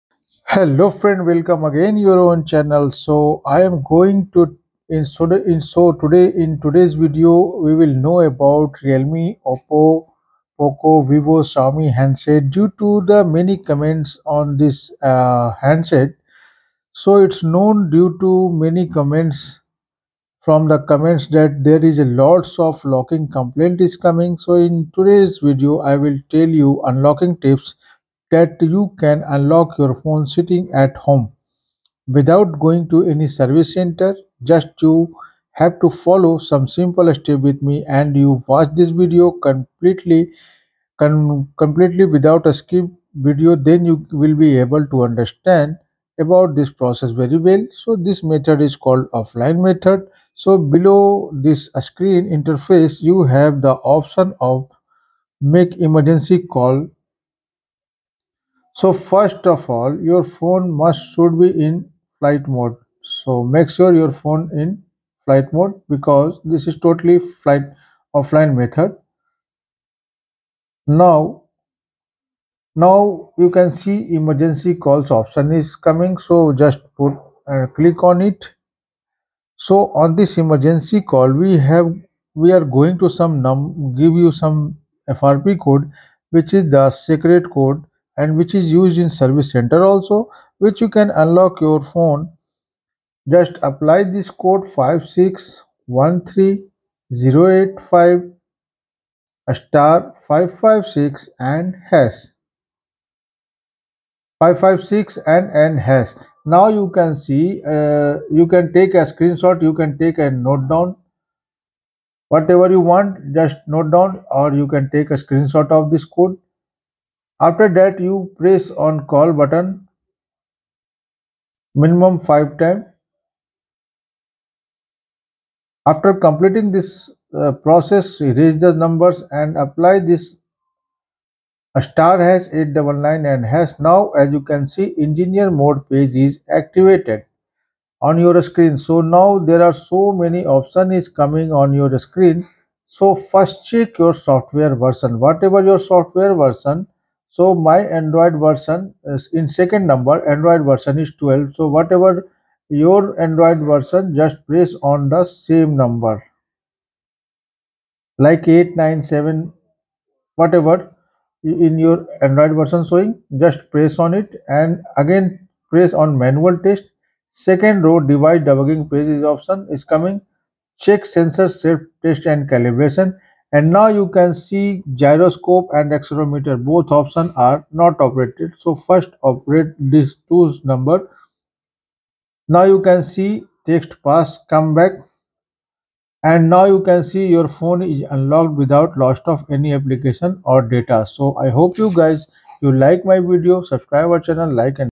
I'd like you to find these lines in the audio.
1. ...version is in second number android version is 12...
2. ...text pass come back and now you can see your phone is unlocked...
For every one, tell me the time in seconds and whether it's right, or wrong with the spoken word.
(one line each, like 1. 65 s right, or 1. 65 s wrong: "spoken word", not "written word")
1. 148 s right
2. 183 s right.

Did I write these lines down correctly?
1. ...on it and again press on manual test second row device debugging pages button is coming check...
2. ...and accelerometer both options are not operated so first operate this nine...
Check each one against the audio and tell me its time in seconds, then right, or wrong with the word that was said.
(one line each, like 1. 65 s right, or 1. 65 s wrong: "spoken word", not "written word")
1. 163 s wrong: "option", not "button"
2. 175 s wrong: "two", not "nine".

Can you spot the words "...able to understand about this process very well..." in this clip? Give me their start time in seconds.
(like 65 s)
44 s.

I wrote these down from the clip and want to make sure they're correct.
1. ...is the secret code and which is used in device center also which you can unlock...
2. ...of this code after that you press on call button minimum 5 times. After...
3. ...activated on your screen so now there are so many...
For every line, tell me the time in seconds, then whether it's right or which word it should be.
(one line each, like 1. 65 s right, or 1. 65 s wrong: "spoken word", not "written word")
1. 86 s wrong: "service", not "device"
2. 115 s right
3. 136 s right.